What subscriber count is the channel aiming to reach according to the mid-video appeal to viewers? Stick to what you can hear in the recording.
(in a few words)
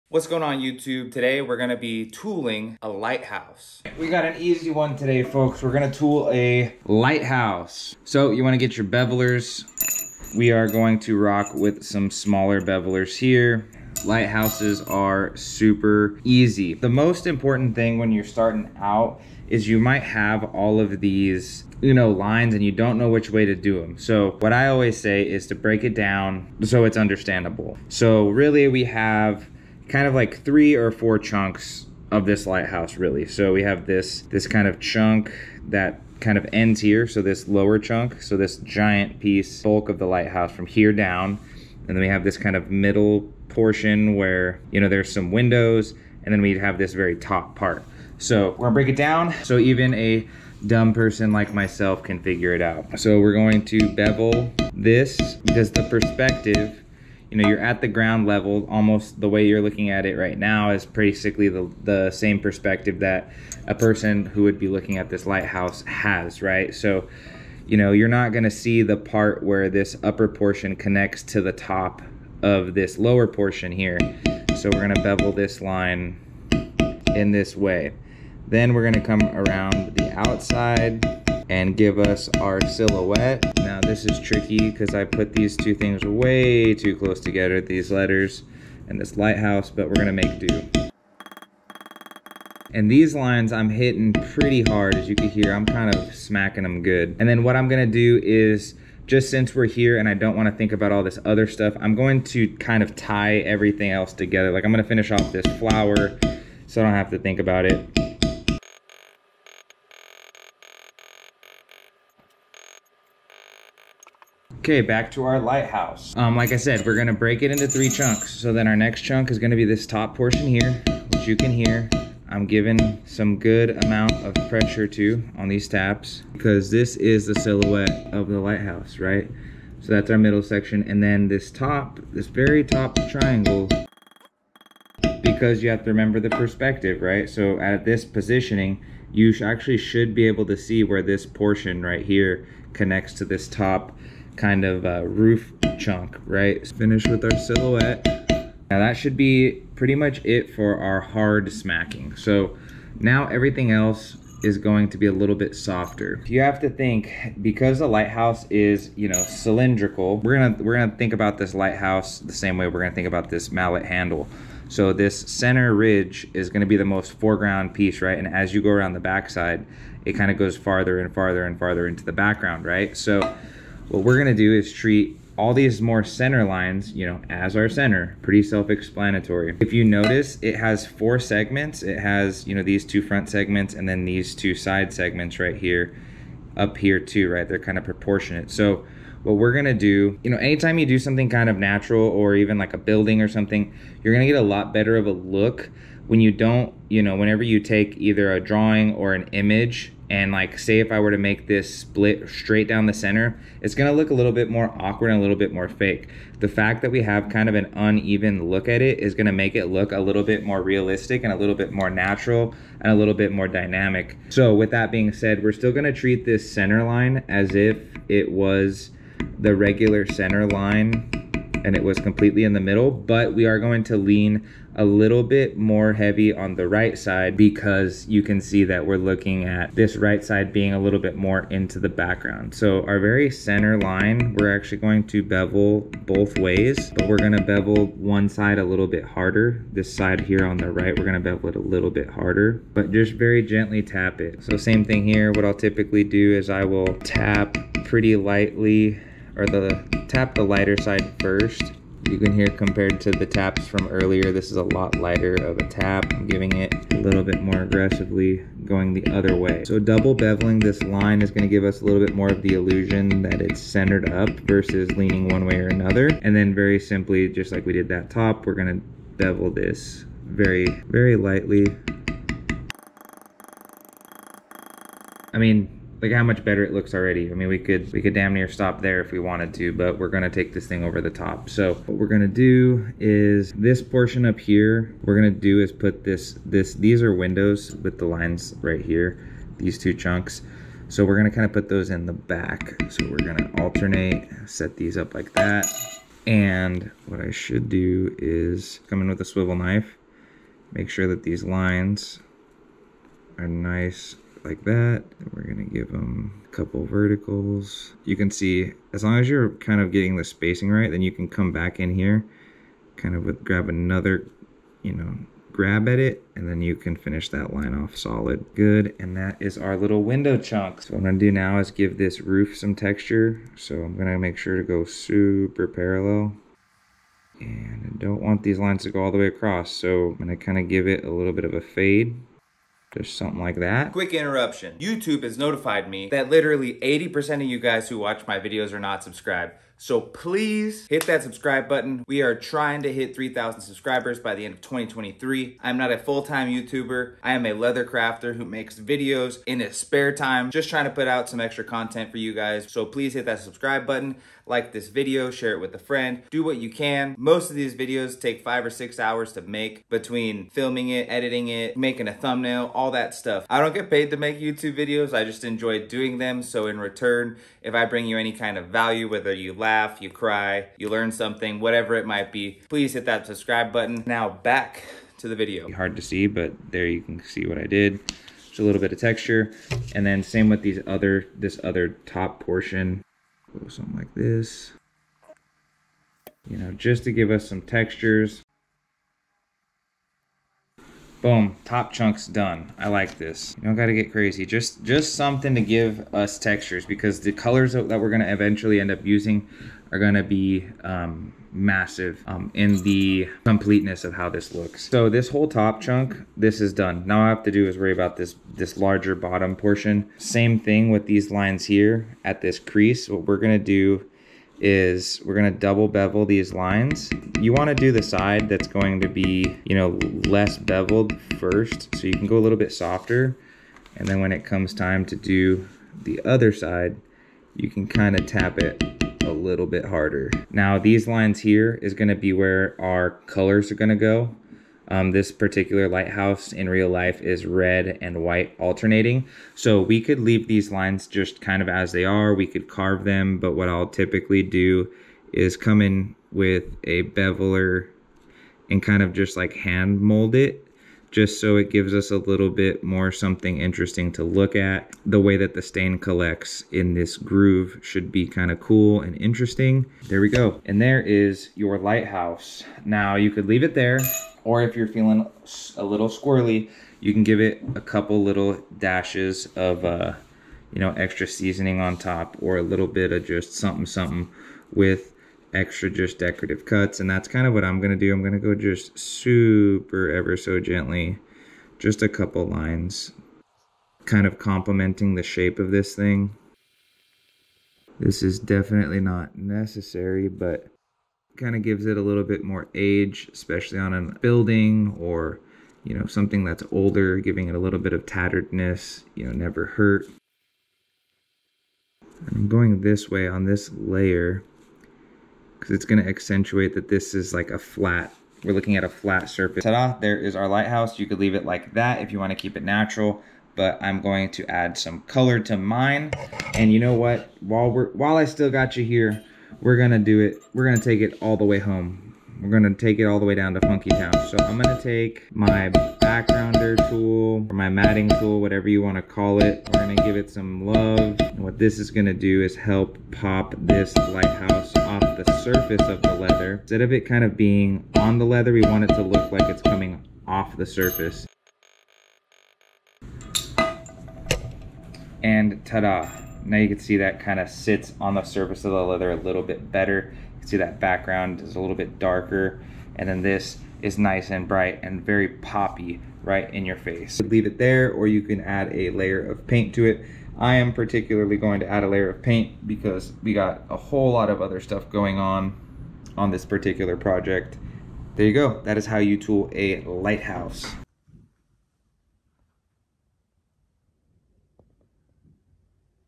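3,000.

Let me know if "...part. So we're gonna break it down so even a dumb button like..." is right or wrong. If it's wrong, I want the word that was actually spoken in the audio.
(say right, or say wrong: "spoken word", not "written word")
wrong: "person", not "button".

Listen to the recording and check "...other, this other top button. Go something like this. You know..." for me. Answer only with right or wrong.
wrong.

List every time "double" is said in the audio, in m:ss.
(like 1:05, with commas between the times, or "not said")
4:19, 6:55.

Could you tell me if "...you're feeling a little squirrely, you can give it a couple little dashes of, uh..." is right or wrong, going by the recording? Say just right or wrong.
right.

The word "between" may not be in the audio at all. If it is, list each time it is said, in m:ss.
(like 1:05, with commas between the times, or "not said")
5:59.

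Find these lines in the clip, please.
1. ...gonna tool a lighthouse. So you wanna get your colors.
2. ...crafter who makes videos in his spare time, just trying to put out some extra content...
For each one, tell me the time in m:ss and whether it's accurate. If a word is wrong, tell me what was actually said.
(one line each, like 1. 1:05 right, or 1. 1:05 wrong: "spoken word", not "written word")
1. 0:05 wrong: "bevelers", not "colors"
2. 5:47 right.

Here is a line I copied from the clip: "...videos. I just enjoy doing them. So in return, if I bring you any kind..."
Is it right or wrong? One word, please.
right.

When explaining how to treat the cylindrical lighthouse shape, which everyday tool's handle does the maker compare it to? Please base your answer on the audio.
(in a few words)
mallet handle.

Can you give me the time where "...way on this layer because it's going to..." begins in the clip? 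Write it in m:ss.
8:23.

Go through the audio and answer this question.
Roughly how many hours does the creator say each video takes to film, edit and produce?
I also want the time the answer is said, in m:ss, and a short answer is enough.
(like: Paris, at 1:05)
5 or 6 hours, at 5:58.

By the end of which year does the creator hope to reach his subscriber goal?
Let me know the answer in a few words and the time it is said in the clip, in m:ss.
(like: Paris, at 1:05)
2023, at 5:44.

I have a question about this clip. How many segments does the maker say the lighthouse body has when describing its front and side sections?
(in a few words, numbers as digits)
4.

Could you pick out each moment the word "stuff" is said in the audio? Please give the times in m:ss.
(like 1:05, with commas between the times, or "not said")
1:41, 6:03, 9:24.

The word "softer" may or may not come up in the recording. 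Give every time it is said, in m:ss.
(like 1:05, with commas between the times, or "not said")
2:35, 7:02.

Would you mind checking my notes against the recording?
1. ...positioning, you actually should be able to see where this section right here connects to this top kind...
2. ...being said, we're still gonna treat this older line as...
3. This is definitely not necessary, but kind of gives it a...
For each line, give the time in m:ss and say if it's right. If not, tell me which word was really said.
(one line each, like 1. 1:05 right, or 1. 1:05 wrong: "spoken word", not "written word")
1. 2:18 wrong: "portion", not "section"
2. 3:34 wrong: "center", not "older"
3. 8:07 right.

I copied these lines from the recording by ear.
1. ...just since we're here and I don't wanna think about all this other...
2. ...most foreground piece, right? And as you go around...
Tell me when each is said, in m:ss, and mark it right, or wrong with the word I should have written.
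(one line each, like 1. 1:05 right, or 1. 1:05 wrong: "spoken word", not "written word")
1. 1:39 right
2. 2:46 right.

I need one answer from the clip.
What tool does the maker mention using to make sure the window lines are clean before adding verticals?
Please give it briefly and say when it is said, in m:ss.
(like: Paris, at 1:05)
swivel knife, at 4:59.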